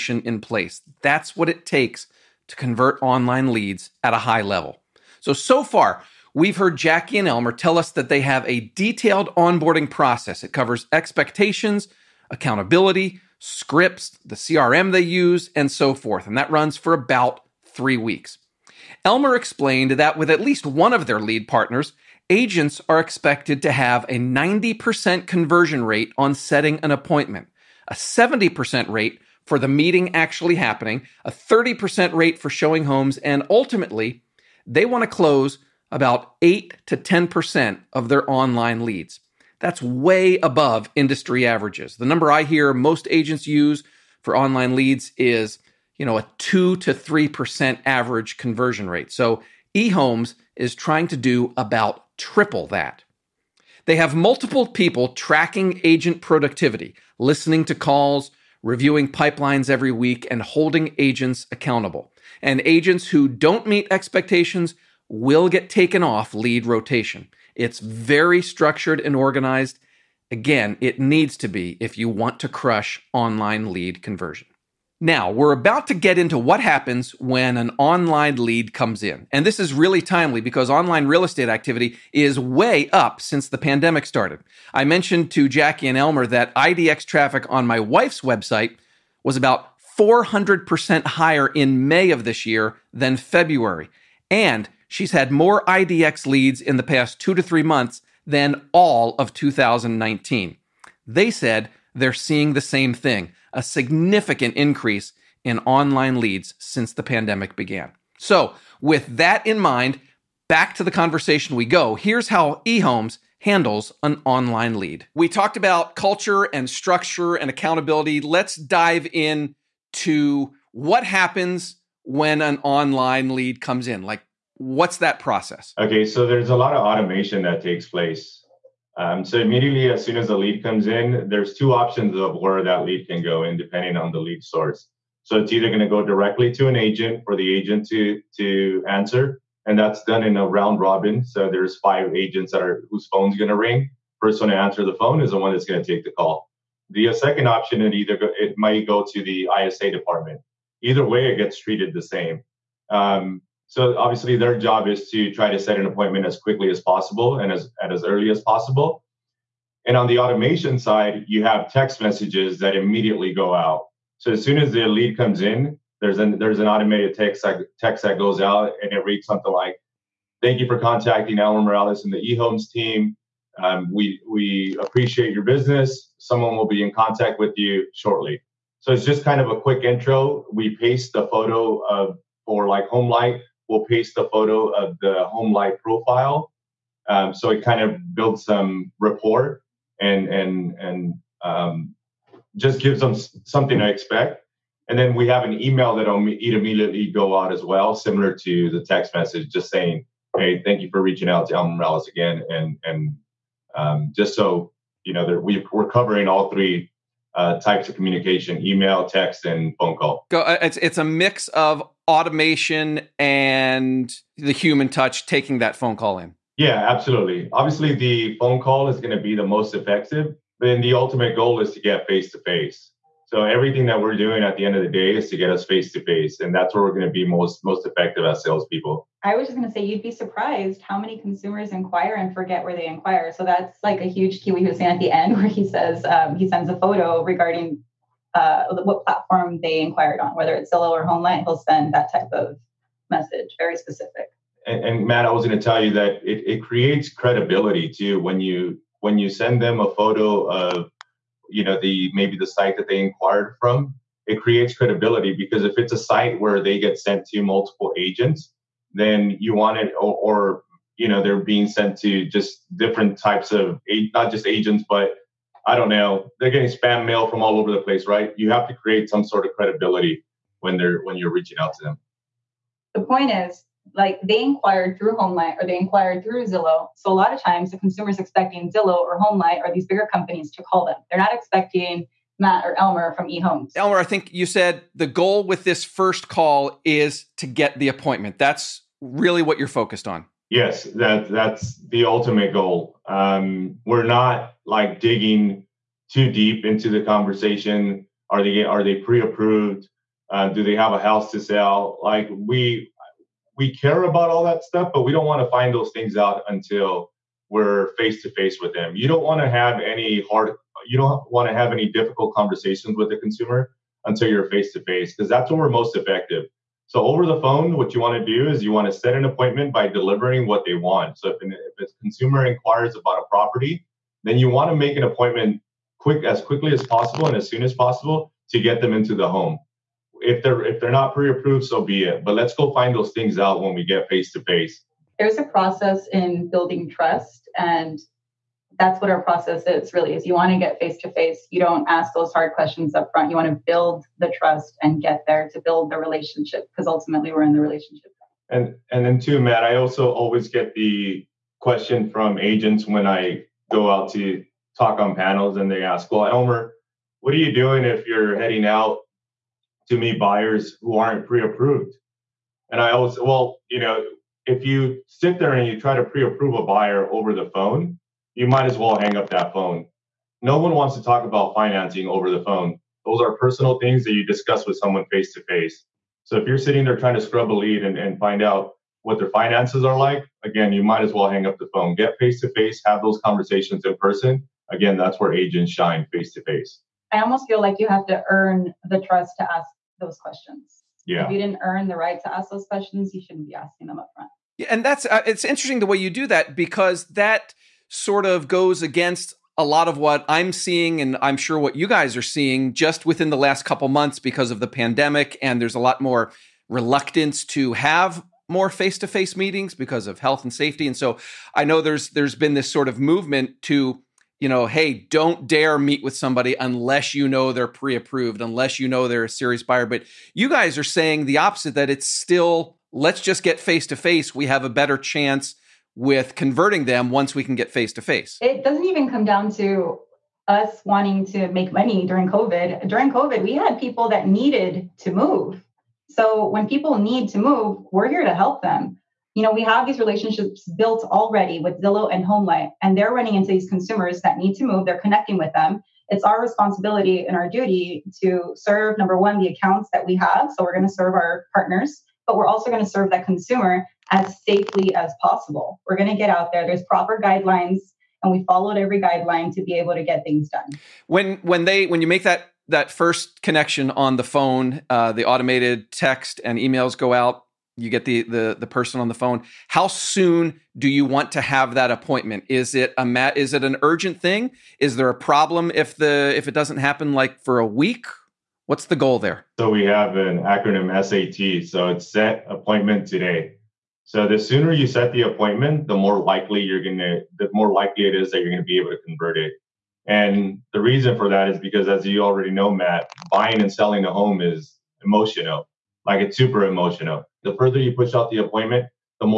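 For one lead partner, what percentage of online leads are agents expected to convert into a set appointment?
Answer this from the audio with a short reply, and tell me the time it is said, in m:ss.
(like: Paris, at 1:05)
90%, at 0:24.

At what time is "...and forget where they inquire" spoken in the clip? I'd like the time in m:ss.
3:52.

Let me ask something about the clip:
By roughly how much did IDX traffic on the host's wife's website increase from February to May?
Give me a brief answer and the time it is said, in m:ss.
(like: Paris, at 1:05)
400%, at 1:29.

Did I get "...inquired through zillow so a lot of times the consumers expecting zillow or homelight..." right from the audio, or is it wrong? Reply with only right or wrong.
right.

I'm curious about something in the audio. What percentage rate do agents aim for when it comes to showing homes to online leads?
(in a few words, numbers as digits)
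30%.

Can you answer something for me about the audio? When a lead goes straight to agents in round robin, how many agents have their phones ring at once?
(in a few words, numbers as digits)
5.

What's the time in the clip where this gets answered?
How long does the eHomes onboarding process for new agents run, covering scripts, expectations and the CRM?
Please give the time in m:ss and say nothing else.
0:16.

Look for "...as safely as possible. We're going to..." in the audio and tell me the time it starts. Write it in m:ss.
7:34.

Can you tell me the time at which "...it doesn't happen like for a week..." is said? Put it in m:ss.
7:56.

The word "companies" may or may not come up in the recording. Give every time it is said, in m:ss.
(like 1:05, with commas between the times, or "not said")
4:40.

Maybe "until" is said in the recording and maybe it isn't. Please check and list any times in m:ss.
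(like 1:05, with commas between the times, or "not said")
5:06, 5:14.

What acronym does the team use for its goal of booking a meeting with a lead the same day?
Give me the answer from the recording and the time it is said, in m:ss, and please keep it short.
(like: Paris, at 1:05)
SAT, at 8:01.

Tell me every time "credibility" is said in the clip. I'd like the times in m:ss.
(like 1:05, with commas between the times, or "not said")
4:07, 4:14, 4:29.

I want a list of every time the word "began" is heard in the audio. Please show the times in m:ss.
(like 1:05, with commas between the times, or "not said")
1:47.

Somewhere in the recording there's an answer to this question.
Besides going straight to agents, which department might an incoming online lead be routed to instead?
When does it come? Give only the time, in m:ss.
2:29.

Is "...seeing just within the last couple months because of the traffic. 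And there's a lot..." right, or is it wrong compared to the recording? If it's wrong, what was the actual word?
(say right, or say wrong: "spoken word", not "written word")
wrong: "pandemic", not "traffic".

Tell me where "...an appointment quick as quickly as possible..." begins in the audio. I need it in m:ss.
5:24.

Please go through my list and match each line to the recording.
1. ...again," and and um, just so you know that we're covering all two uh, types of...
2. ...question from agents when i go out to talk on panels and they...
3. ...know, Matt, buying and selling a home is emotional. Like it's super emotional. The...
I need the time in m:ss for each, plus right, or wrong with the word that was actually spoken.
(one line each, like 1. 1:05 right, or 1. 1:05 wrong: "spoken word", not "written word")
1. 3:22 wrong: "three", not "two"
2. 5:51 right
3. 8:12 right.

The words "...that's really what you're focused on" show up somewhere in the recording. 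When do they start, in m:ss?
4:48.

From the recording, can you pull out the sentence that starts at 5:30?
If they're if they're not pre-approved, so be it.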